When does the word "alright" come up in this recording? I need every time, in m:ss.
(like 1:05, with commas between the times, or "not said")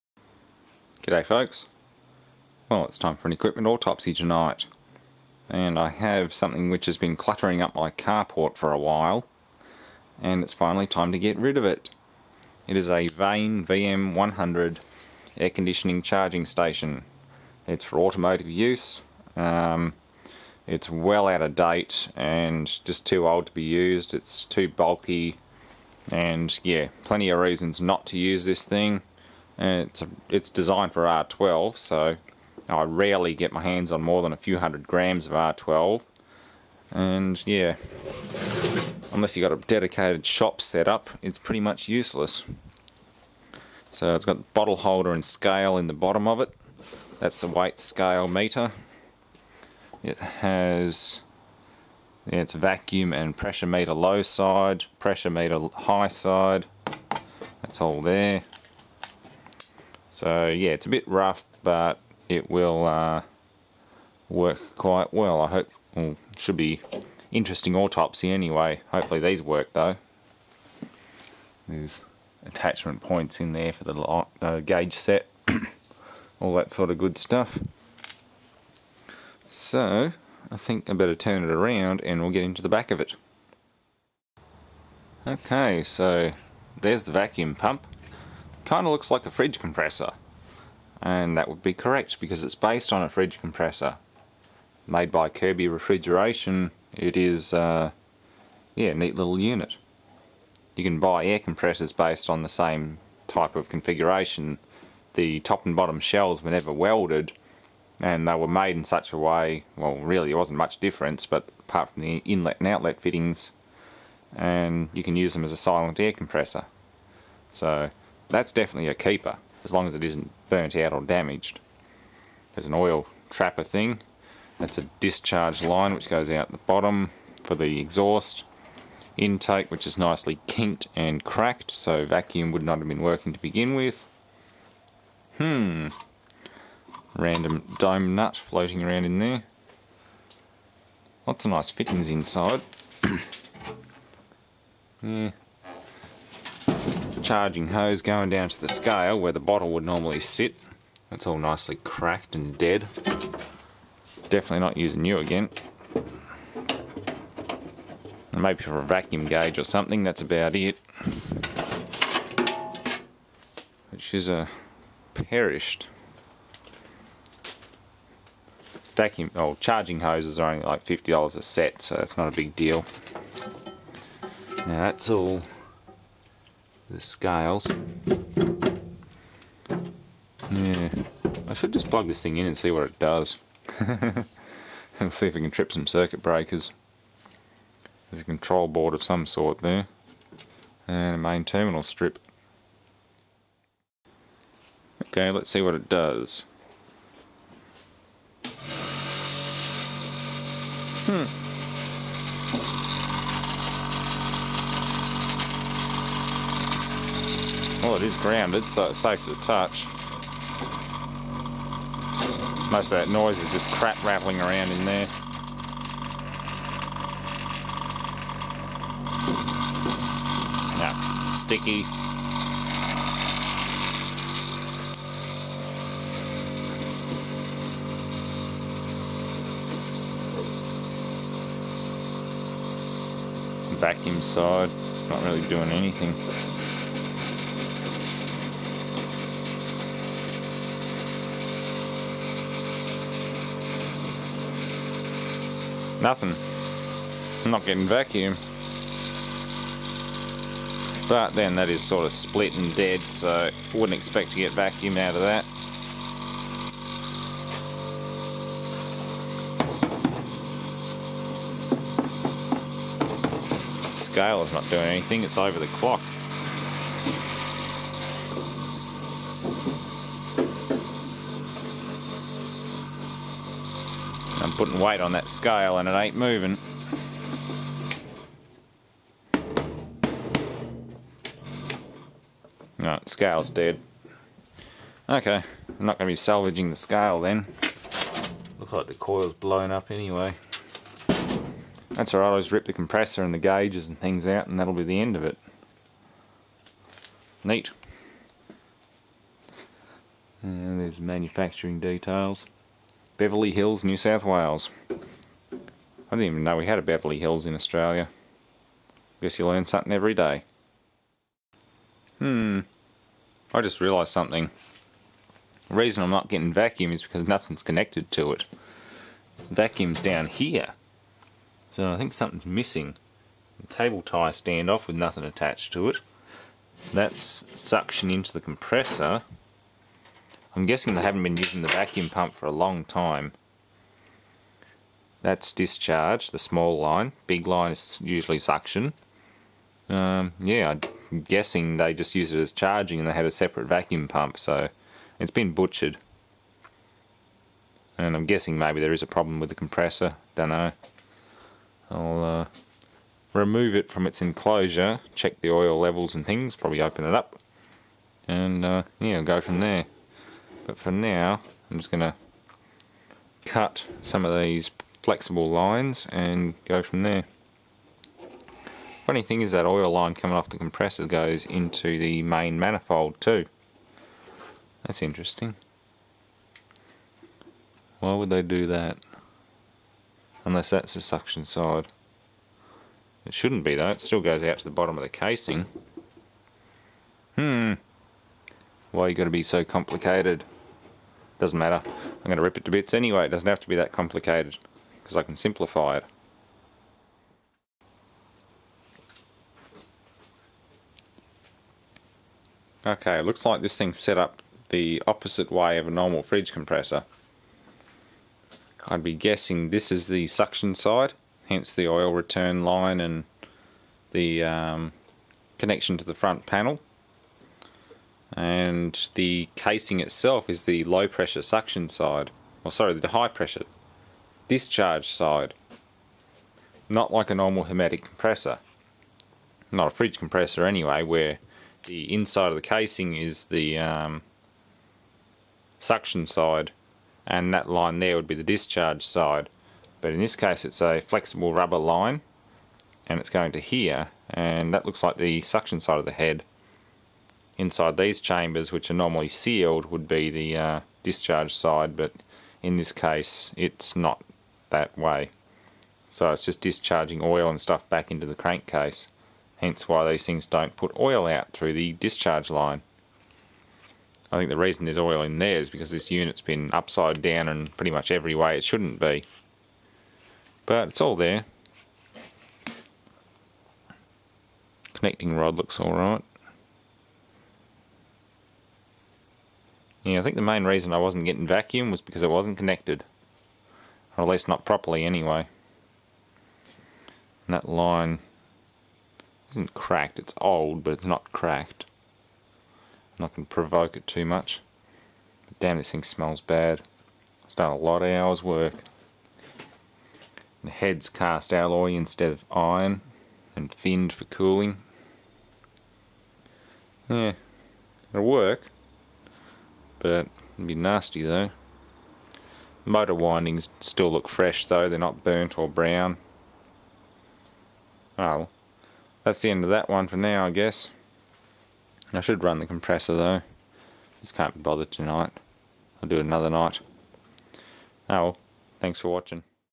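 4:52, 7:55.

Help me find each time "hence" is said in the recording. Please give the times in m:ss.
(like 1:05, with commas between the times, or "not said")
6:51, 7:39.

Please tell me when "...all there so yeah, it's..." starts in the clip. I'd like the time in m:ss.
0:57.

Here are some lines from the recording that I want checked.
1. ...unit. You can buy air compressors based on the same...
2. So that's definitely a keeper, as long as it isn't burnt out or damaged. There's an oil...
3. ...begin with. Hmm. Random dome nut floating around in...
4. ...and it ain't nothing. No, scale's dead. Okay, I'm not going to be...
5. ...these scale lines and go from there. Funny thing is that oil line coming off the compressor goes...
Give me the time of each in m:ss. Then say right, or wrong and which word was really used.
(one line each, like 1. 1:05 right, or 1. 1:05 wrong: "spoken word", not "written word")
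1. 1:39 right
2. 1:57 right
3. 2:13 right
4. 4:35 wrong: "moving", not "nothing"
5. 6:04 wrong: "flexible", not "scale".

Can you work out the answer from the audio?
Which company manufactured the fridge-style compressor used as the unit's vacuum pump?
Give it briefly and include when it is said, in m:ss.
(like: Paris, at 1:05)
Kirby Refrigeration, at 1:35.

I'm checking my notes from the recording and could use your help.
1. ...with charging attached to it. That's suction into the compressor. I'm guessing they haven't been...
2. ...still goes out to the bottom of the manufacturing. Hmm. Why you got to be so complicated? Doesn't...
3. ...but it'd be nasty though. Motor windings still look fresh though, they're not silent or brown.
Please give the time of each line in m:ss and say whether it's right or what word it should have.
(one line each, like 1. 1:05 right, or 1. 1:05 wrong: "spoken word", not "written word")
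1. 5:24 wrong: "nothing", not "charging"
2. 6:24 wrong: "casing", not "manufacturing"
3. 8:30 wrong: "burnt", not "silent".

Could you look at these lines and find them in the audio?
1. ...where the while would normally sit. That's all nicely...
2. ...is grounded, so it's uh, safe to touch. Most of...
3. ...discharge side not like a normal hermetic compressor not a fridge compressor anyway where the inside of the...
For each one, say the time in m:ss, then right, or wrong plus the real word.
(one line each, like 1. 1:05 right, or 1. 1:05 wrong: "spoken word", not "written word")
1. 2:29 wrong: "bottle", not "while"
2. 3:28 right
3. 7:04 right.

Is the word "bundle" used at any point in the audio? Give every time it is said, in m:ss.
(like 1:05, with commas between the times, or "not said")
not said.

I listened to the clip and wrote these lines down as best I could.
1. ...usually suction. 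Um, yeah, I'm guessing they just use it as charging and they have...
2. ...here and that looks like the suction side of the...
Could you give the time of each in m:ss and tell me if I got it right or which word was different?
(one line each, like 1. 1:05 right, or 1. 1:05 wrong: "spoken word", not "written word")
1. 5:38 right
2. 7:23 right.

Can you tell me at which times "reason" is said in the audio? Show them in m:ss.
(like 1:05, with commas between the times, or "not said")
0:27, 5:15, 7:44, 8:00.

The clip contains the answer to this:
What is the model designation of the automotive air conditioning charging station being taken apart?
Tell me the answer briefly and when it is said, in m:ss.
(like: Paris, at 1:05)
Vane VM100, at 0:13.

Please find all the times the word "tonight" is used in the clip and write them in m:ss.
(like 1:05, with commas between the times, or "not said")
0:04, 8:44.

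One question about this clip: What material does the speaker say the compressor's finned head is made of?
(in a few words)
Cast alloy.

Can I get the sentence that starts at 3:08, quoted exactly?
There's a control board of some sort there.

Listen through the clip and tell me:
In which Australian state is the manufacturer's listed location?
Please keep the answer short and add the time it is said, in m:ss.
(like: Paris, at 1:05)
New South Wales, at 5:03.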